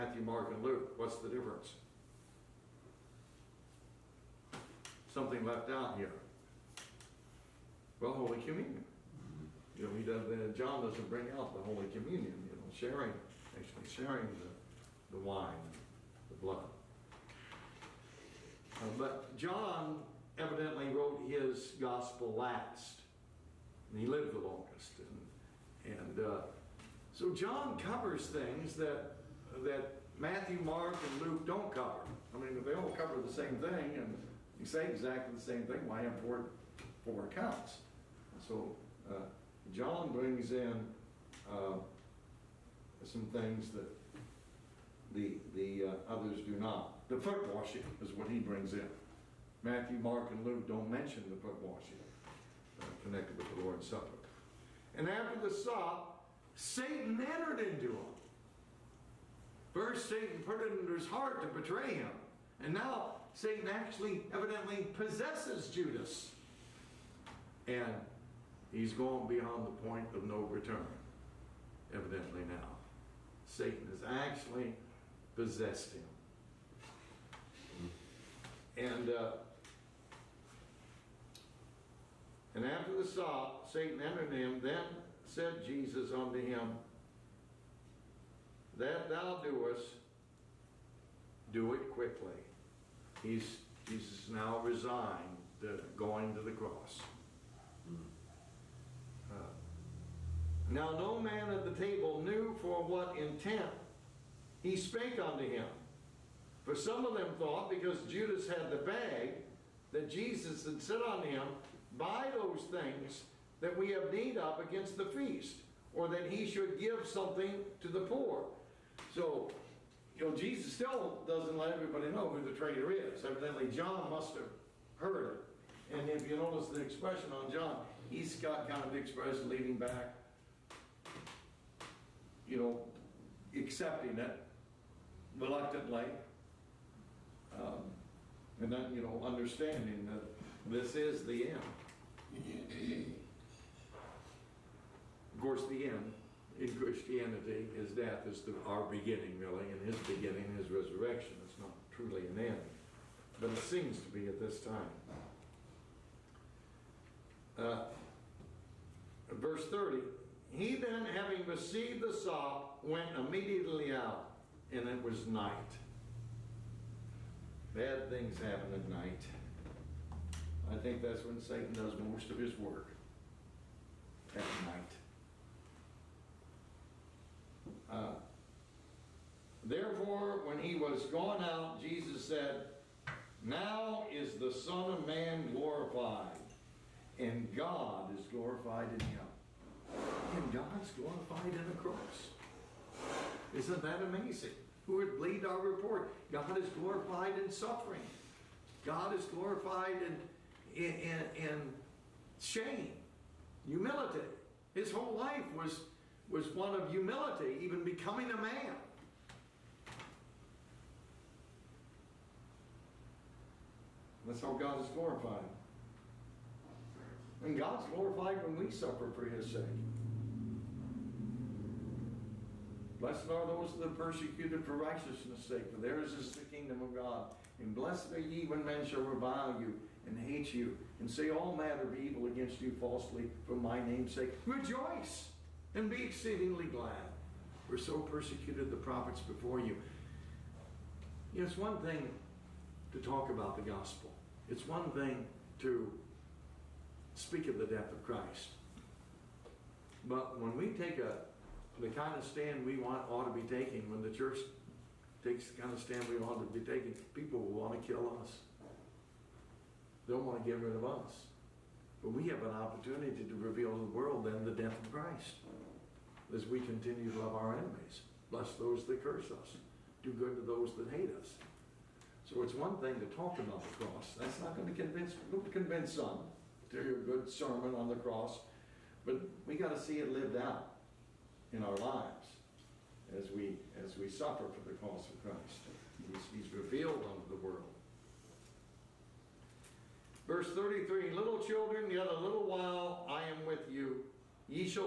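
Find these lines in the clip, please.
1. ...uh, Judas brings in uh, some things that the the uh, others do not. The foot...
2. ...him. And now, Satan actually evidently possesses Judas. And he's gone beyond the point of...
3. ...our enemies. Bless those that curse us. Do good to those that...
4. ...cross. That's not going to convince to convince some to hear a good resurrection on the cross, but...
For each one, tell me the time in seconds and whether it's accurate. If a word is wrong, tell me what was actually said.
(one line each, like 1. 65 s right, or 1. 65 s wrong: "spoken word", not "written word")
1. 39 s wrong: "John", not "Judas"
2. 61 s right
3. 267 s right
4. 273 s wrong: "sermon", not "resurrection".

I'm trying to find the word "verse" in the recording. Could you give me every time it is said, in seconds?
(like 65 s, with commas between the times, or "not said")
159 s, 290 s.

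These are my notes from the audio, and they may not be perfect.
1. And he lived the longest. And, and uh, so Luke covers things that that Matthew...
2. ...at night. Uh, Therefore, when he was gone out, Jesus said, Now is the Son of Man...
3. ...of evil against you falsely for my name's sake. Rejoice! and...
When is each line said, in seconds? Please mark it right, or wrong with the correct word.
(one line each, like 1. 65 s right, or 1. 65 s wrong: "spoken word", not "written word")
1. 23 s wrong: "John", not "Luke"
2. 174 s right
3. 231 s right.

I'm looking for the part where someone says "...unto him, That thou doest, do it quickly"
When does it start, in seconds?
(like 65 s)
86 s.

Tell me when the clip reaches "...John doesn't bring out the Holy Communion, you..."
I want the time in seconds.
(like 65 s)
10 s.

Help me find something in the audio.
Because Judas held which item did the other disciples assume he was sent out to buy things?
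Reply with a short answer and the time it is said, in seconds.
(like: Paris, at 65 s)
The bag, at 108 s.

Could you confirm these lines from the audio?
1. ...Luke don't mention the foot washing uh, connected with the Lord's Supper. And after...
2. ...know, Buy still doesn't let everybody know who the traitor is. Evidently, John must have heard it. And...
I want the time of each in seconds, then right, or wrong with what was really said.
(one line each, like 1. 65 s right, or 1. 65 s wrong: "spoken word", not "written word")
1. 50 s right
2. 120 s wrong: "Jesus", not "Buy".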